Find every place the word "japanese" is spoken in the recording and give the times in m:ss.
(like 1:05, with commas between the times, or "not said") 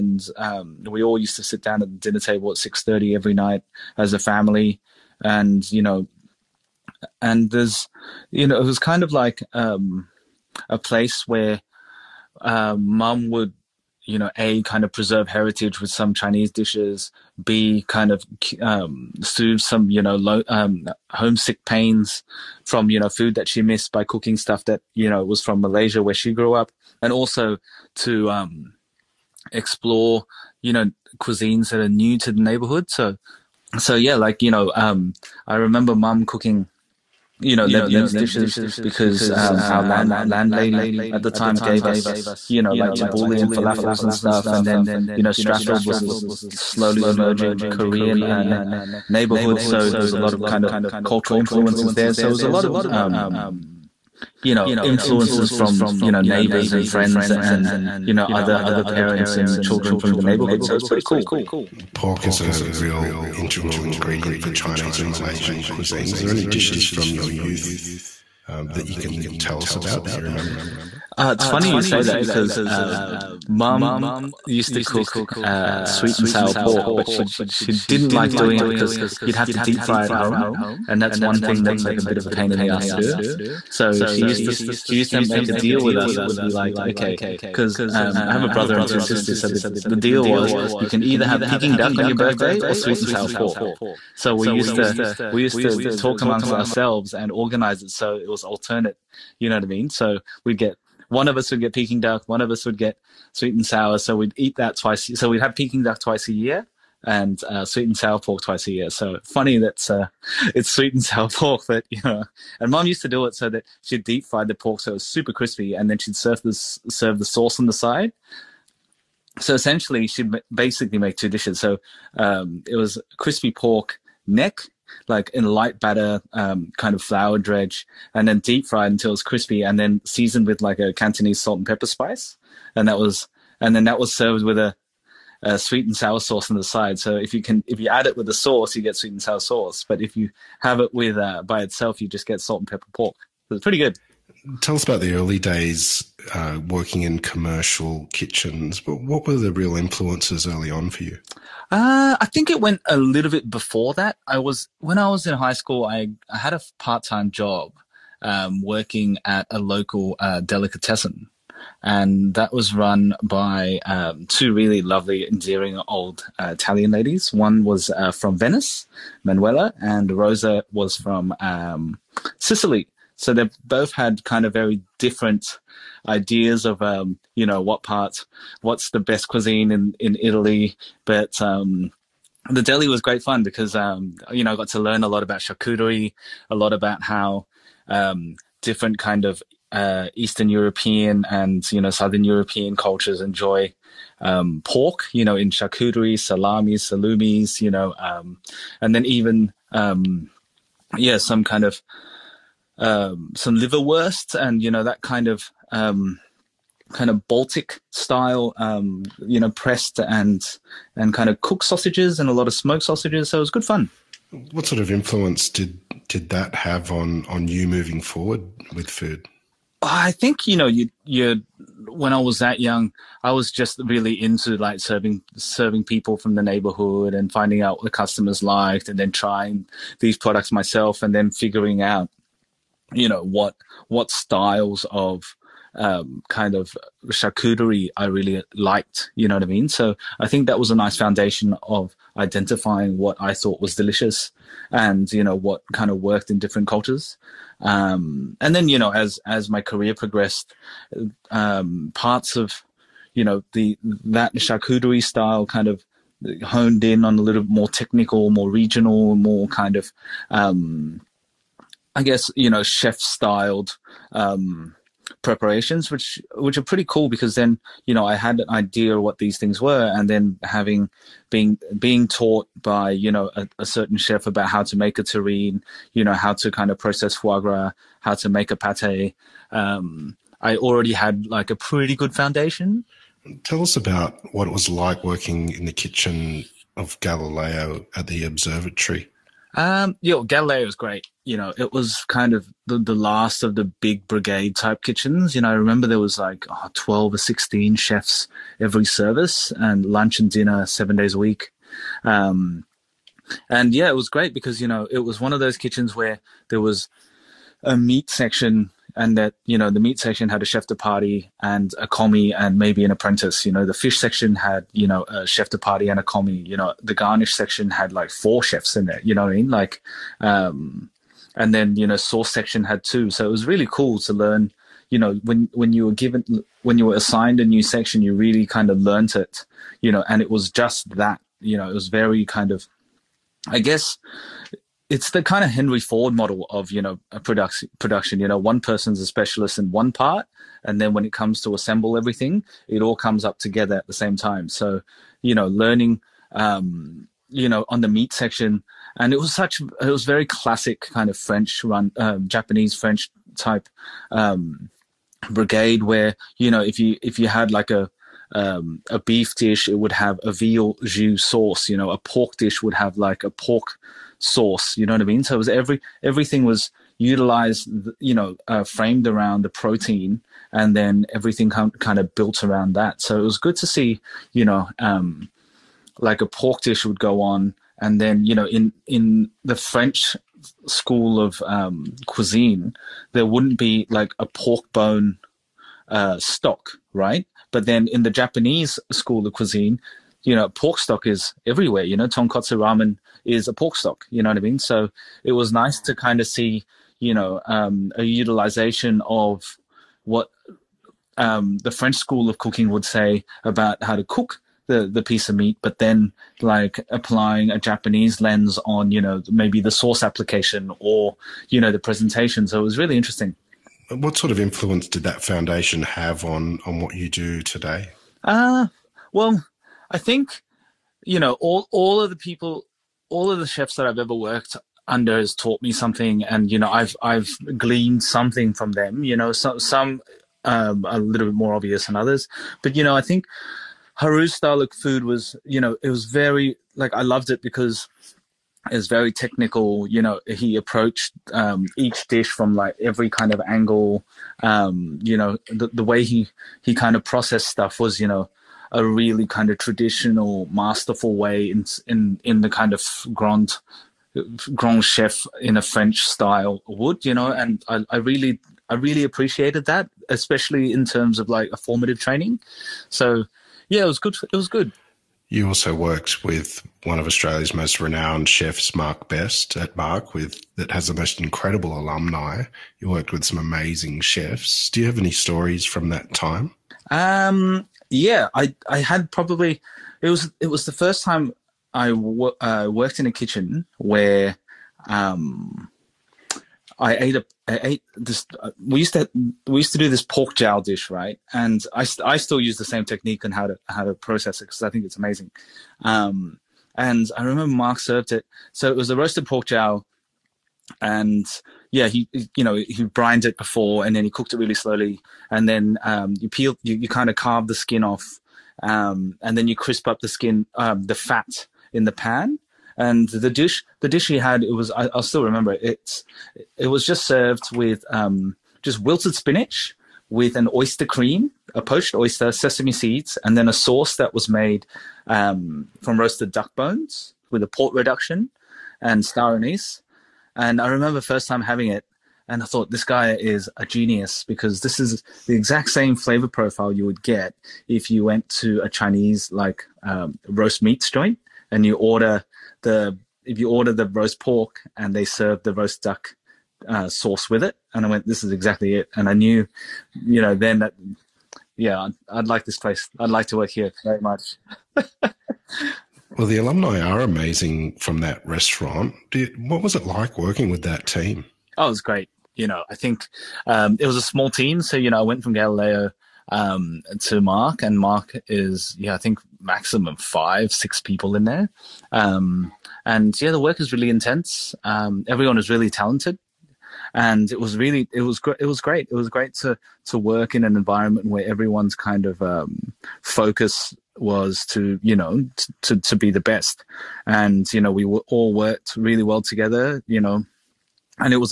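5:52, 6:28, 6:47.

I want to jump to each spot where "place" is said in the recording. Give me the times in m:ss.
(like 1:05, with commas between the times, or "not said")
0:10, 9:12.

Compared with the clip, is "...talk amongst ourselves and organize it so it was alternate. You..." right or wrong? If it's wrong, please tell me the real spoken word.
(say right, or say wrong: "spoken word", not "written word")
right.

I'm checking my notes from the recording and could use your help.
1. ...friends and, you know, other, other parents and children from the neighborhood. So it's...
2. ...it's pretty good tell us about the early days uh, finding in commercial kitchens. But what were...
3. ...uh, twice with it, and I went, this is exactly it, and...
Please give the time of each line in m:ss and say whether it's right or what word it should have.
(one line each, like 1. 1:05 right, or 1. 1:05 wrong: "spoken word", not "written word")
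1. 0:56 right
2. 2:23 wrong: "working", not "finding"
3. 9:06 wrong: "sauce", not "twice".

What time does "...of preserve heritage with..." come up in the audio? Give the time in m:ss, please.
0:14.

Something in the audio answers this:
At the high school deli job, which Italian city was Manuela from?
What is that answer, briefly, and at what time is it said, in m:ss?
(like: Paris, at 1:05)
Venice, at 2:48.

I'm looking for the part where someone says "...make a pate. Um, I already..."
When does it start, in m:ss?
4:38.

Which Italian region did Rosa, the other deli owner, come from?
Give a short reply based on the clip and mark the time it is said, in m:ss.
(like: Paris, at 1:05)
Sicily, at 2:52.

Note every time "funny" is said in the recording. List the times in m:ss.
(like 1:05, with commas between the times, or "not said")
1:11, 1:49.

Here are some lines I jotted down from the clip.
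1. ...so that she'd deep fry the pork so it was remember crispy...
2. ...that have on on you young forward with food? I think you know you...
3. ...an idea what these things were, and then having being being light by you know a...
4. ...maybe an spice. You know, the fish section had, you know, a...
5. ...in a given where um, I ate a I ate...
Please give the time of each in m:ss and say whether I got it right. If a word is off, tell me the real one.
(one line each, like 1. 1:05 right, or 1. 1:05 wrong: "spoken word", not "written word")
1. 1:53 wrong: "super", not "remember"
2. 3:36 wrong: "moving", not "young"
3. 4:28 wrong: "taught", not "light"
4. 5:12 wrong: "apprentice", not "spice"
5. 8:02 wrong: "kitchen", not "given".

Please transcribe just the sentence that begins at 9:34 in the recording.
Um, everyone is really talented, and it was really it was it was great.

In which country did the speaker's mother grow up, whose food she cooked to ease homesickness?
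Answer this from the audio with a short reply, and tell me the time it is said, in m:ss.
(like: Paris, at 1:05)
Malaysia, at 0:25.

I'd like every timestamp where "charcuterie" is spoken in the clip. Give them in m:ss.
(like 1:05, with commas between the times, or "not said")
3:05, 3:15, 3:57, 4:14.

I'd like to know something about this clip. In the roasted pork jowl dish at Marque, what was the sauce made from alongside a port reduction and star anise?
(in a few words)
Roasted duck bones.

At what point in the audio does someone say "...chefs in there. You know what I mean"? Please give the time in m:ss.
5:18.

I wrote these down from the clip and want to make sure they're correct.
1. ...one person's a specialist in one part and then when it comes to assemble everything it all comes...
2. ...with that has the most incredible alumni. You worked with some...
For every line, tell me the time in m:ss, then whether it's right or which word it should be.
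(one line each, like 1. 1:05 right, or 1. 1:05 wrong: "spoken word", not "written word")
1. 5:38 right
2. 7:50 right.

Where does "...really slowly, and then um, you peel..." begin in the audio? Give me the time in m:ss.
8:24.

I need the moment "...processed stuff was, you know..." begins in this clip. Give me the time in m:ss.
7:27.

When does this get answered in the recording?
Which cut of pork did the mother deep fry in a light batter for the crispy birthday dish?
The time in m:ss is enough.
2:03.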